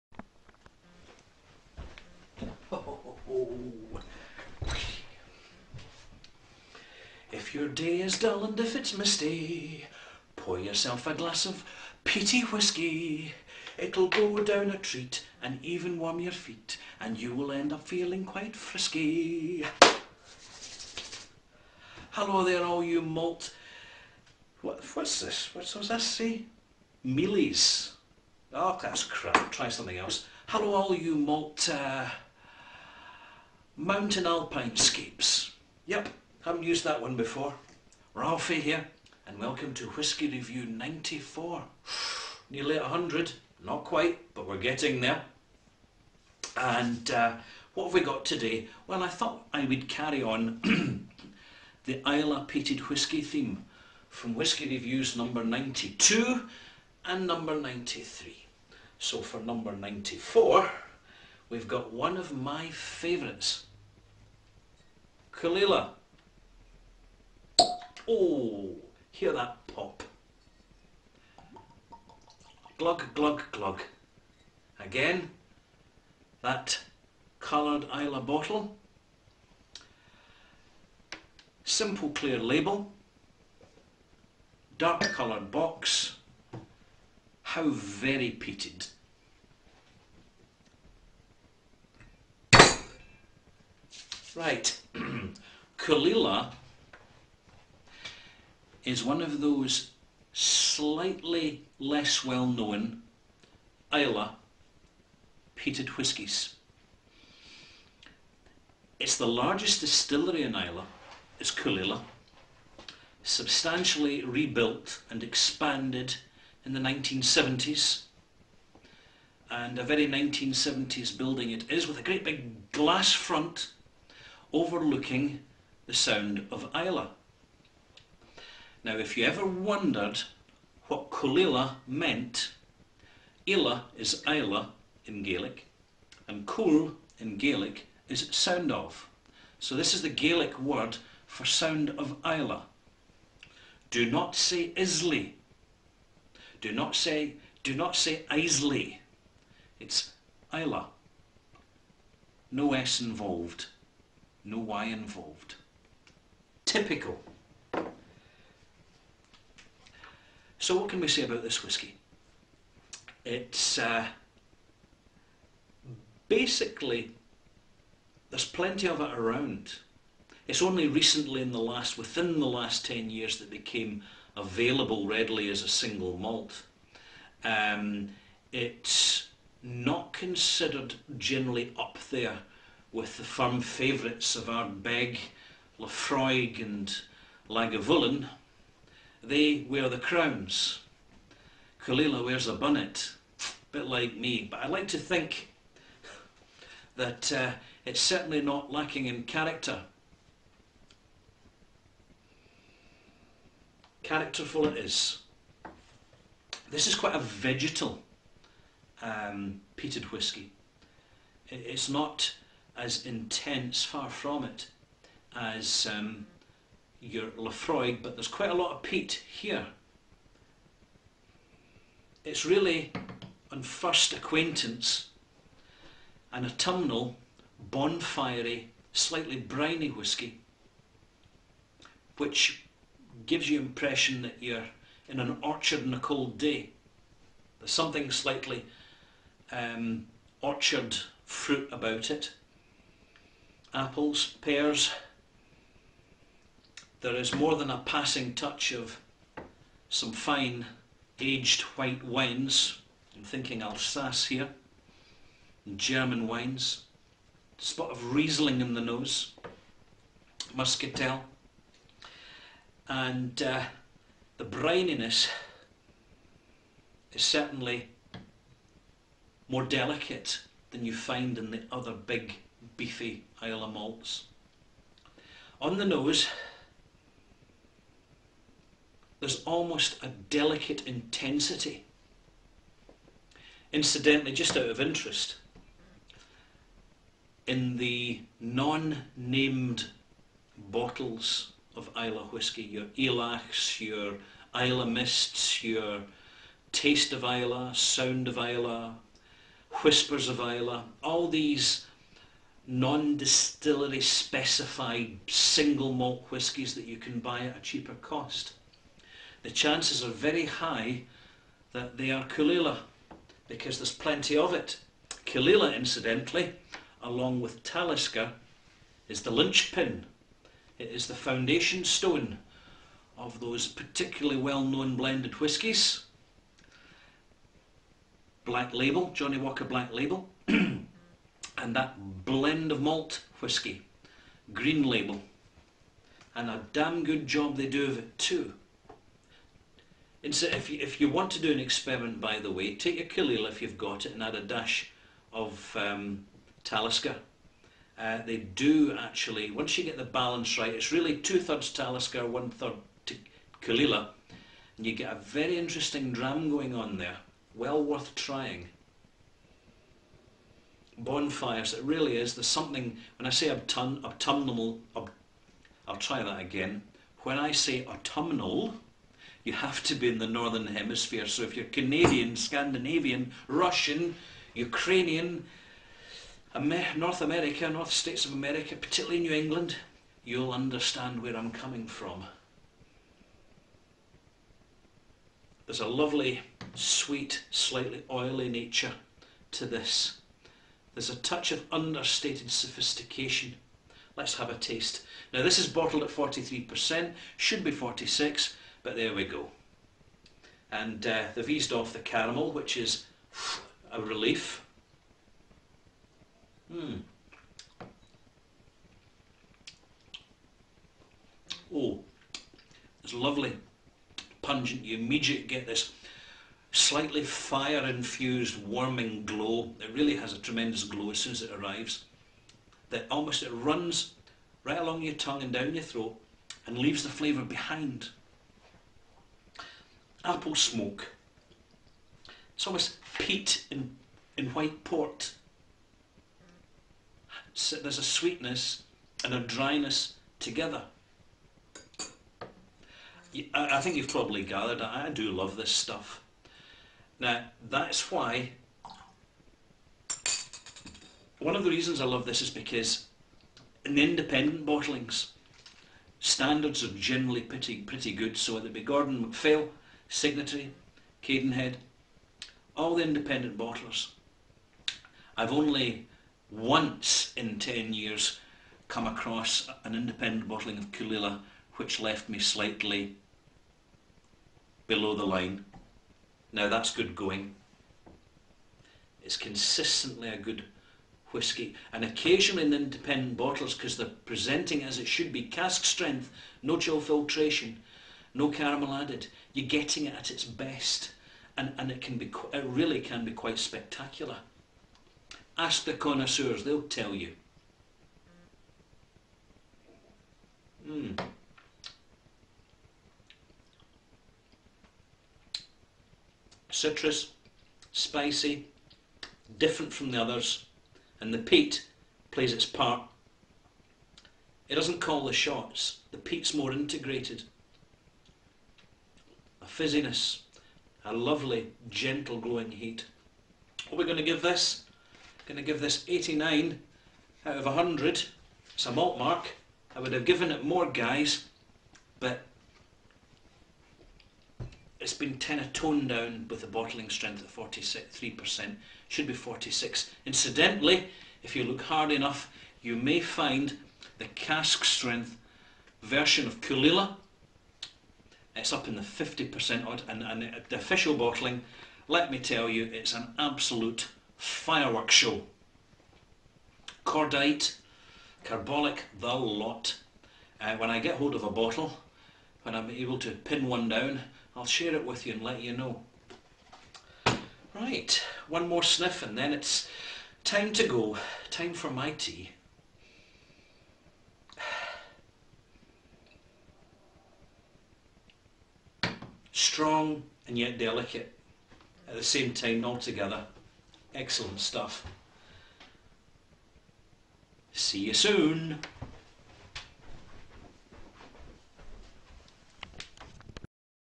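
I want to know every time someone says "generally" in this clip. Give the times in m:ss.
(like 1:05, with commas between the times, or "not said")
3:01, 7:36.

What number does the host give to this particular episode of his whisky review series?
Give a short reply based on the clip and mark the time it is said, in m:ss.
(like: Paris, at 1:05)
94, at 0:39.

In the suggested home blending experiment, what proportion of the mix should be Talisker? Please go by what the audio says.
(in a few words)
two-thirds.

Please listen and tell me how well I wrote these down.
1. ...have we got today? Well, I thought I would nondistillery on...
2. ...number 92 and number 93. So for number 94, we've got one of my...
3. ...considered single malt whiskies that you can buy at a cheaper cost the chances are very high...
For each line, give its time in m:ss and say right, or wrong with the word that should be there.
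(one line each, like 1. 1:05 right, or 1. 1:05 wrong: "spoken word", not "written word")
1. 0:47 wrong: "carry", not "nondistillery"
2. 0:55 right
3. 5:04 wrong: "specified", not "considered".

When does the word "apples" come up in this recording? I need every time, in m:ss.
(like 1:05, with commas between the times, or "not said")
4:03, 7:10.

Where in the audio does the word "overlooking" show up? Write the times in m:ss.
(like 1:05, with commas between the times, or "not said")
2:04.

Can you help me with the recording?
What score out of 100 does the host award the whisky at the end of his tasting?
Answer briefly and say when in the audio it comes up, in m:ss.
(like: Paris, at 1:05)
89, at 8:46.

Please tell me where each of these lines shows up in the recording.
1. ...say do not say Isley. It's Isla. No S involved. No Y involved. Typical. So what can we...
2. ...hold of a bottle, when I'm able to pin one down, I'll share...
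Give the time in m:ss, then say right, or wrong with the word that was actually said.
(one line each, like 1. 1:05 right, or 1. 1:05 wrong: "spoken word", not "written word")
1. 2:26 right
2. 9:21 right.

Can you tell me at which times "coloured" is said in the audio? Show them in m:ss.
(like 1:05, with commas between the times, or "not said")
1:17, 1:25.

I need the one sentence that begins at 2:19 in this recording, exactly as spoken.
So this is the Gaelic word for sound of Isla.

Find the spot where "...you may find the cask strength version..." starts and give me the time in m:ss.
9:02.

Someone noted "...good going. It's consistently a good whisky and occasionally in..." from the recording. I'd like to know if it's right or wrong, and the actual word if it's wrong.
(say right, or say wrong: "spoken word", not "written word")
right.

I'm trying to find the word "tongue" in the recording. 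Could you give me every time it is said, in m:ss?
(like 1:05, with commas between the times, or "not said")
7:05.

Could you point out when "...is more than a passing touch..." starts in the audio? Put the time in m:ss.
4:07.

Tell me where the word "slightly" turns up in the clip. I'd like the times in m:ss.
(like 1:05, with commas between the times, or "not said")
1:40, 3:48, 3:58, 6:27, 6:56, 7:52.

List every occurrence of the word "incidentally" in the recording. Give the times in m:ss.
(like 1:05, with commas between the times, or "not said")
4:43, 5:15, 9:00.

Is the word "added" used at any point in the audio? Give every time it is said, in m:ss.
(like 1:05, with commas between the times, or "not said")
8:08.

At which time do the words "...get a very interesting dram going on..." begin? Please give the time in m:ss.
5:54.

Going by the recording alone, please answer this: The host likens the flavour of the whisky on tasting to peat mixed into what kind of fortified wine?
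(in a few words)
white port.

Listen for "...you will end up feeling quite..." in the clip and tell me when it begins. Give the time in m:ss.
0:17.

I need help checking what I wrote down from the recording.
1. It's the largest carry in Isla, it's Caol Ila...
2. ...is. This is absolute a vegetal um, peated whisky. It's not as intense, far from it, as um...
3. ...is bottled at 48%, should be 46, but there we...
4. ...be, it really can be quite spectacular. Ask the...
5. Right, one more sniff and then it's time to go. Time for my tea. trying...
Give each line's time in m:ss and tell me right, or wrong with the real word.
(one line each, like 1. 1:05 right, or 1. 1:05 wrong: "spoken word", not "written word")
1. 1:48 wrong: "distillery", not "carry"
2. 3:24 wrong: "quite", not "absolute"
3. 6:35 wrong: "43", not "48"
4. 8:12 right
5. 9:27 wrong: "strong", not "trying".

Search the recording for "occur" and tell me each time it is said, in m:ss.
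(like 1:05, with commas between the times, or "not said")
not said.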